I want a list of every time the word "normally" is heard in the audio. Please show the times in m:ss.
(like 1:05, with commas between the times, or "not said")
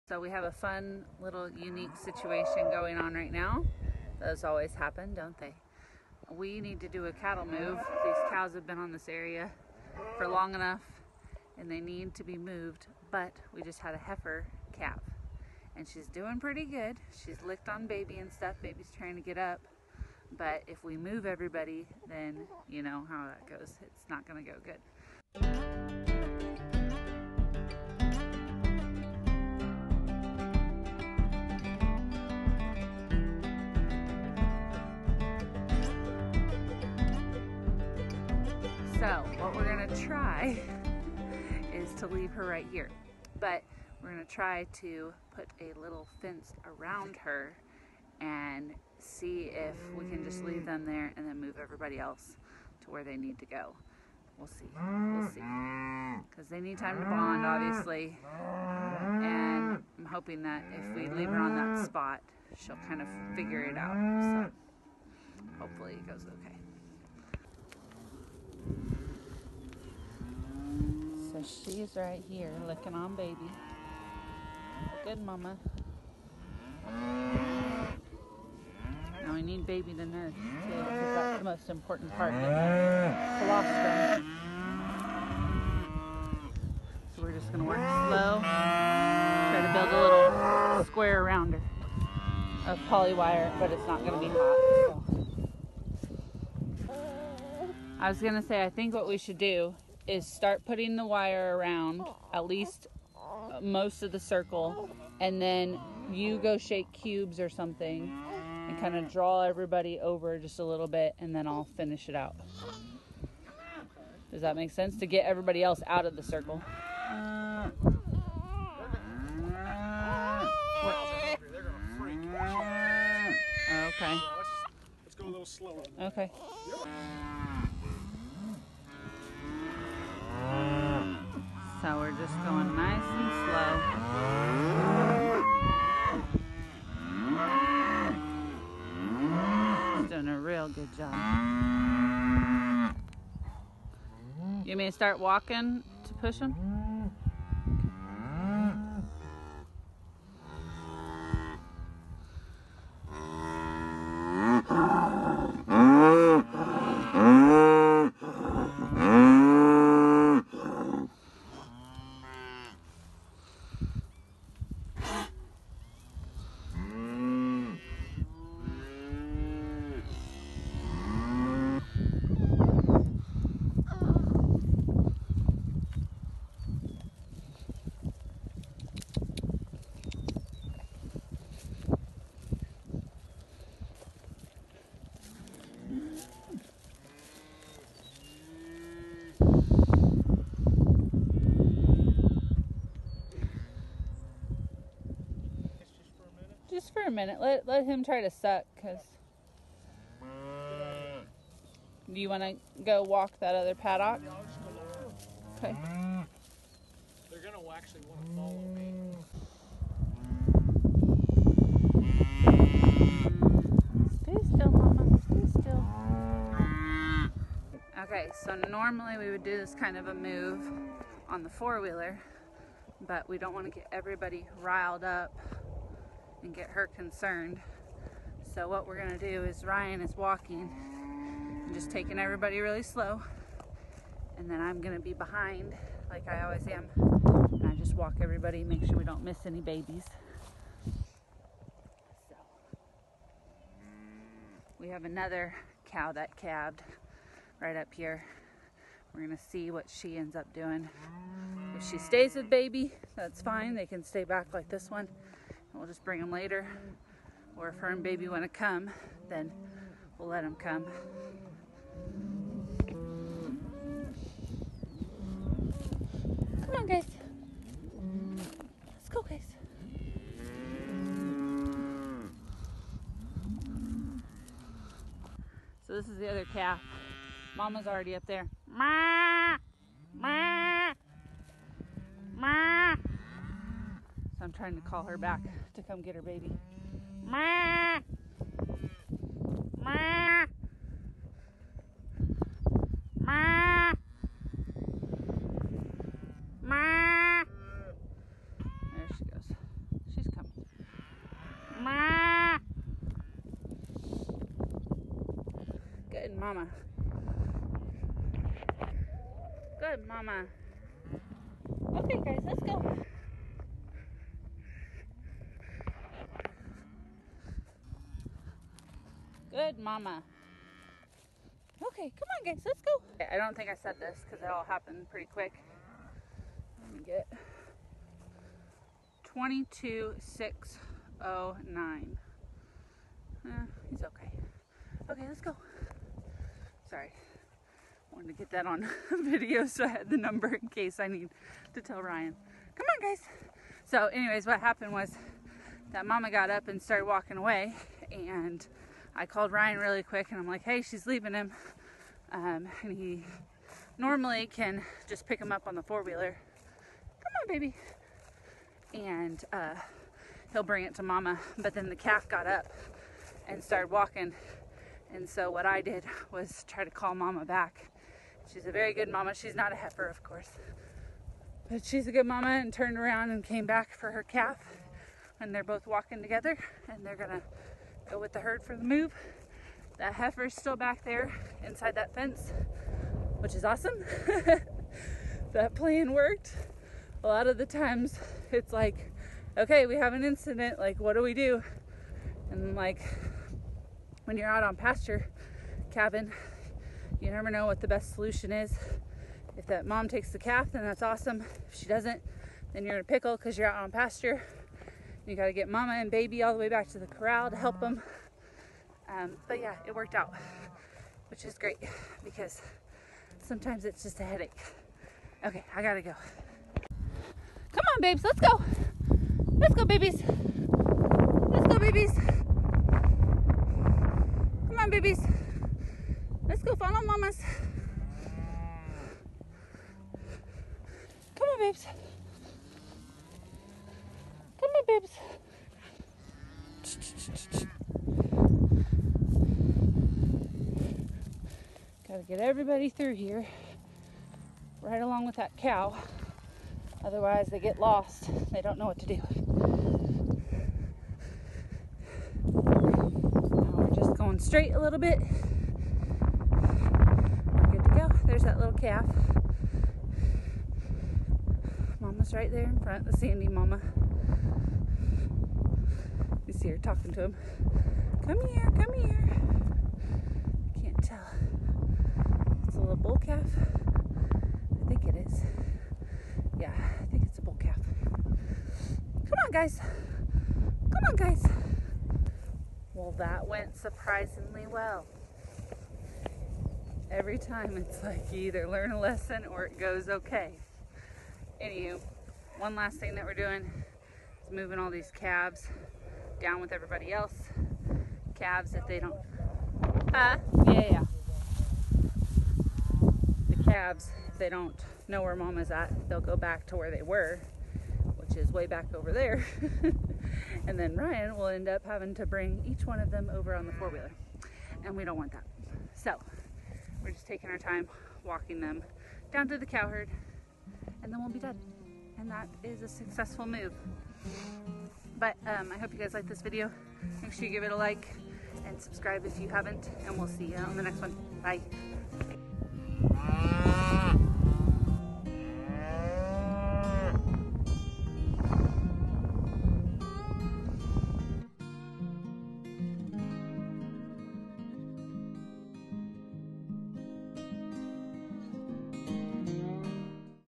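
3:38, 5:53.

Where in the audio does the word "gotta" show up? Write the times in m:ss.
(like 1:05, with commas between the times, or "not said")
6:45, 6:55, 7:22.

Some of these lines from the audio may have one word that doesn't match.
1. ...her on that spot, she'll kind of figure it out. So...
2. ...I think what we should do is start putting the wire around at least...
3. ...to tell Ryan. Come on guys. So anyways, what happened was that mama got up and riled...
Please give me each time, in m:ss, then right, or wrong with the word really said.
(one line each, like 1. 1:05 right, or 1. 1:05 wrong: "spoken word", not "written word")
1. 1:01 right
2. 1:38 right
3. 5:41 wrong: "started", not "riled".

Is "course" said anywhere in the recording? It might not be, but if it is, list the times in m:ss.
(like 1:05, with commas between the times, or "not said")
6:10.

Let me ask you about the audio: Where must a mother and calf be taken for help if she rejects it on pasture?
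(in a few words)
The corral.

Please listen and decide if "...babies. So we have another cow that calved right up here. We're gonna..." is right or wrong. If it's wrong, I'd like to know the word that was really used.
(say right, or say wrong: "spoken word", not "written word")
right.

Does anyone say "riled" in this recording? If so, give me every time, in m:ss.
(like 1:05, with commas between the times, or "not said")
3:44.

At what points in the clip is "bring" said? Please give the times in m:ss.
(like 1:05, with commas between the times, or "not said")
4:16, 6:00, 8:32.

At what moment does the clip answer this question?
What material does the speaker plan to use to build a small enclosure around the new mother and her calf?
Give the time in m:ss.
1:32.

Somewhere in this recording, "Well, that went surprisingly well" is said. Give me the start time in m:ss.
8:02.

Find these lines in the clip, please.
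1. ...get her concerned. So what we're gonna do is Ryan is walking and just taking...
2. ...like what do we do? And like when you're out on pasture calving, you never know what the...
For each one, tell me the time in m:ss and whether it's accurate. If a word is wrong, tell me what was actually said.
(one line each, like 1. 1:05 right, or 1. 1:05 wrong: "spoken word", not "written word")
1. 3:46 right
2. 6:30 right.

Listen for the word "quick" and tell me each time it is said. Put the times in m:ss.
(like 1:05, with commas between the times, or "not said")
5:25, 5:50.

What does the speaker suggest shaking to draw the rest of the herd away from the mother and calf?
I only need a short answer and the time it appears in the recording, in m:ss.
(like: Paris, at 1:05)
Cubes, at 1:46.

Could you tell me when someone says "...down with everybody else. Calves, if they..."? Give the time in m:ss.
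8:16.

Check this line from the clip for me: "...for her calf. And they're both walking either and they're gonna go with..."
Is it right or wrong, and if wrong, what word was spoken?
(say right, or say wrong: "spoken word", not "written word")
wrong: "together", not "either".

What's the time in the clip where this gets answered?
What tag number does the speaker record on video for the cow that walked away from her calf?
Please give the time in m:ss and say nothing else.
5:29.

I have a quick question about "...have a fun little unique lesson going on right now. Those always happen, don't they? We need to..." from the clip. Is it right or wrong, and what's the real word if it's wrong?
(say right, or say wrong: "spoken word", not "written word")
wrong: "situation", not "lesson".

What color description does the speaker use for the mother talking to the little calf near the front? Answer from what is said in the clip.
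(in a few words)
Sandy.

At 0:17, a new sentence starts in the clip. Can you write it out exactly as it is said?
She's licked on baby and stuff.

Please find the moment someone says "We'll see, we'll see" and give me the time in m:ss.
0:54.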